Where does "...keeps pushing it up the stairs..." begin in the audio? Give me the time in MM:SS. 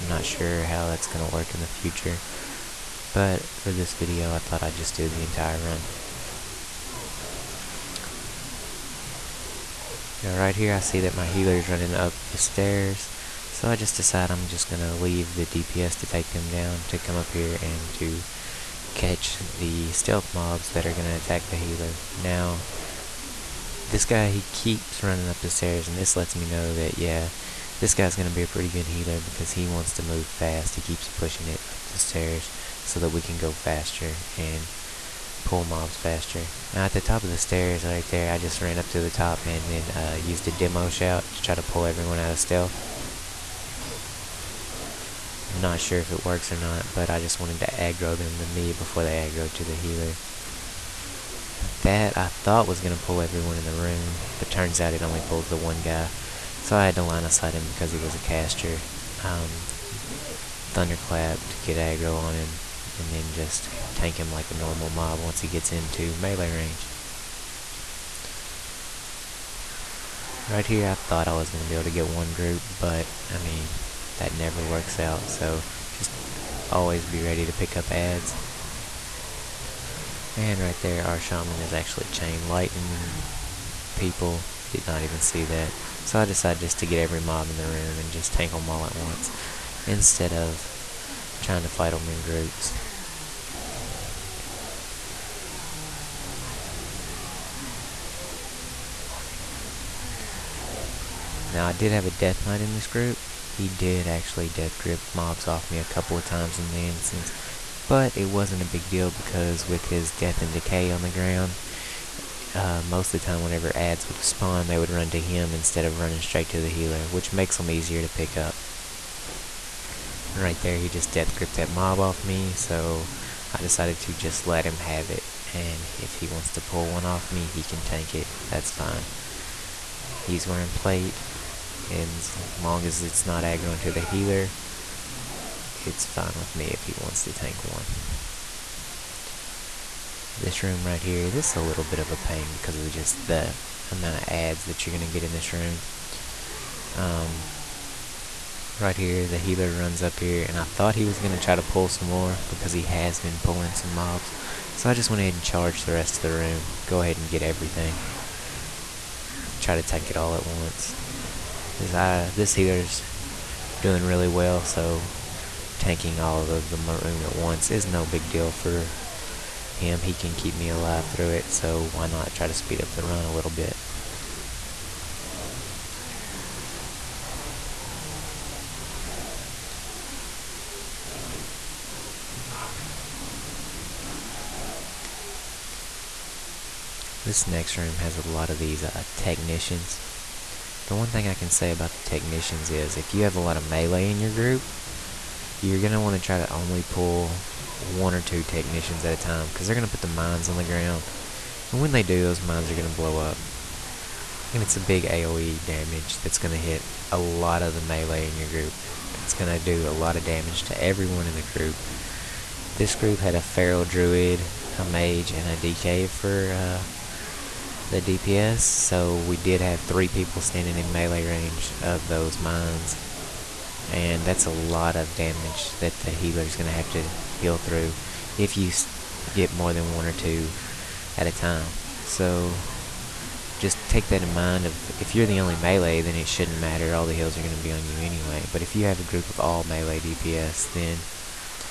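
00:30.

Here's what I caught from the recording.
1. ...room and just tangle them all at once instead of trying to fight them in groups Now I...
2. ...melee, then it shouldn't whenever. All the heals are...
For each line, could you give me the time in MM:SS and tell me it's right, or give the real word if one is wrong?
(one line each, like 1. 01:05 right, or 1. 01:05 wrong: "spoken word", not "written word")
1. 01:27 right
2. 03:55 wrong: "matter", not "whenever".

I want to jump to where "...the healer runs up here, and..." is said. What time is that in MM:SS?
02:29.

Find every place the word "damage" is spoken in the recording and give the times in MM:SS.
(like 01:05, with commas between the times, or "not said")
03:25, 03:30, 03:45.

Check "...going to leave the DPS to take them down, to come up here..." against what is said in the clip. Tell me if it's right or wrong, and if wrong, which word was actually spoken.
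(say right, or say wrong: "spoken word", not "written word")
right.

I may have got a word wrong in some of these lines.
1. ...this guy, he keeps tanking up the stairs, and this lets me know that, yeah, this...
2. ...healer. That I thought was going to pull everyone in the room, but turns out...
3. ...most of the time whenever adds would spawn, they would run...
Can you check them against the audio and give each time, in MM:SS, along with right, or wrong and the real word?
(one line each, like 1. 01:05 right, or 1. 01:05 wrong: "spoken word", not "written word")
1. 00:23 wrong: "running", not "tanking"
2. 00:49 right
3. 01:52 right.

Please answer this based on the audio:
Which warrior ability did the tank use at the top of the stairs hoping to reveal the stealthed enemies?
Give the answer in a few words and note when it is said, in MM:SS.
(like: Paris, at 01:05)
demo shout, at 00:40.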